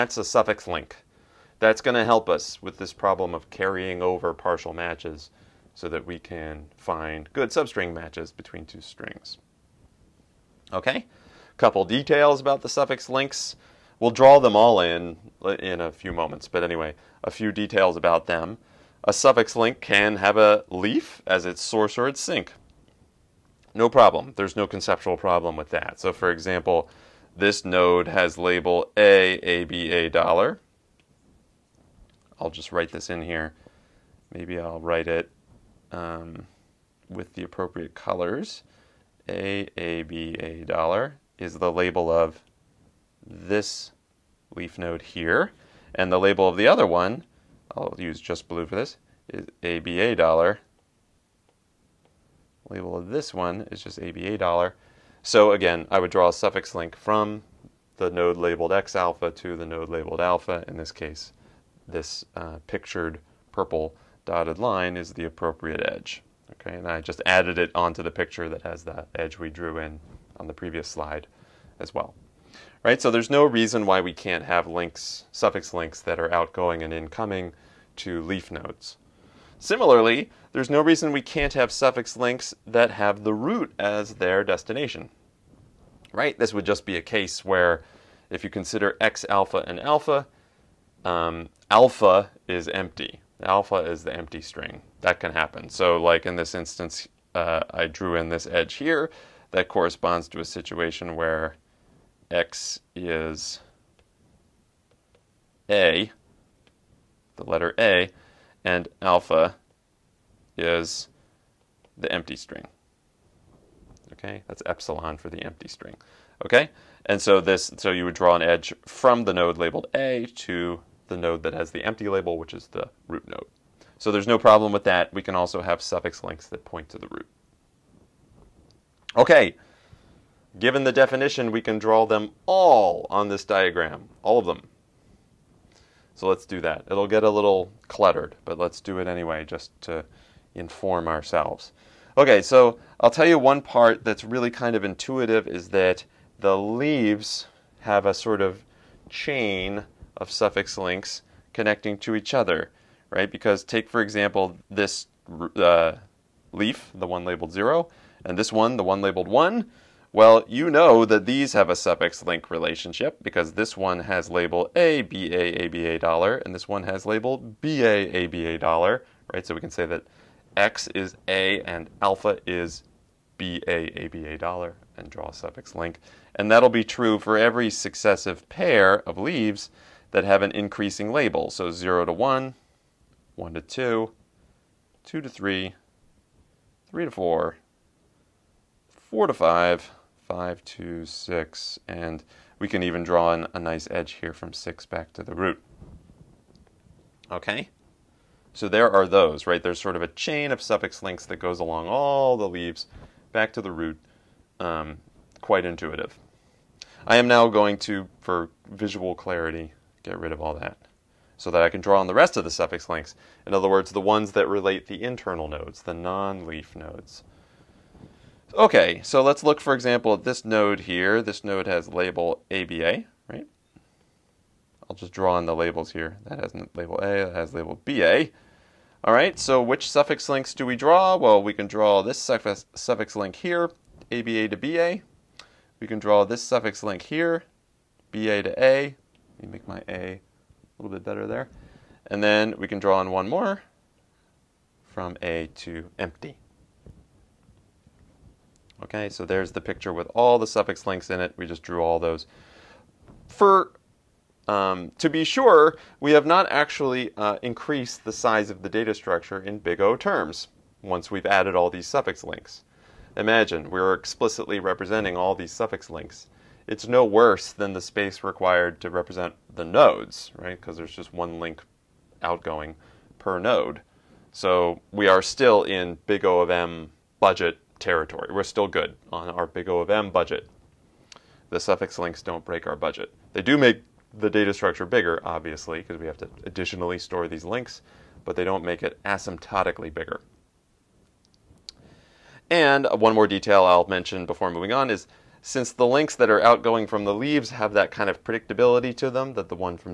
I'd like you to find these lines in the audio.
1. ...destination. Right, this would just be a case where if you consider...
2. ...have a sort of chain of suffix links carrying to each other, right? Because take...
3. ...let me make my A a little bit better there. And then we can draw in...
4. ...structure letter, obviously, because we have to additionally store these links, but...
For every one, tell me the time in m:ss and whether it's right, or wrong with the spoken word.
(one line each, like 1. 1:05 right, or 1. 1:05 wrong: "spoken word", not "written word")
1. 1:24 right
2. 2:27 wrong: "connecting", not "carrying"
3. 3:59 right
4. 4:44 wrong: "bigger", not "letter".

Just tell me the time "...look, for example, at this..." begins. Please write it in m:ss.
3:39.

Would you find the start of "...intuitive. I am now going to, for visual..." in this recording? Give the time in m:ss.
3:25.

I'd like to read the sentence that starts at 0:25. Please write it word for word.
So for example, this node has label a a b a dollar.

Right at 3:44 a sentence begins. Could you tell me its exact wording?
I'll just draw in the labels here.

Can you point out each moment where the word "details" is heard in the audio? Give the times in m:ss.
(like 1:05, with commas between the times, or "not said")
0:11, 0:17, 4:53.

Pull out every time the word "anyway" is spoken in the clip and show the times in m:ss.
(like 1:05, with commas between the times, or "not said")
0:16, 2:19.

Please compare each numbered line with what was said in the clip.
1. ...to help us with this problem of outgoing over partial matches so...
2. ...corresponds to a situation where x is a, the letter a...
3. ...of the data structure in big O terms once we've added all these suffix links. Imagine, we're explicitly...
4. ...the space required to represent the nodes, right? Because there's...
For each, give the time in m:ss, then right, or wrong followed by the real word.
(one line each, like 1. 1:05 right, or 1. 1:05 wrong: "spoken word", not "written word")
1. 0:01 wrong: "carrying", not "outgoing"
2. 1:39 right
3. 4:18 right
4. 4:27 right.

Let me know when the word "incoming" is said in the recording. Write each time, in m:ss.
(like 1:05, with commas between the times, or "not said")
1:16.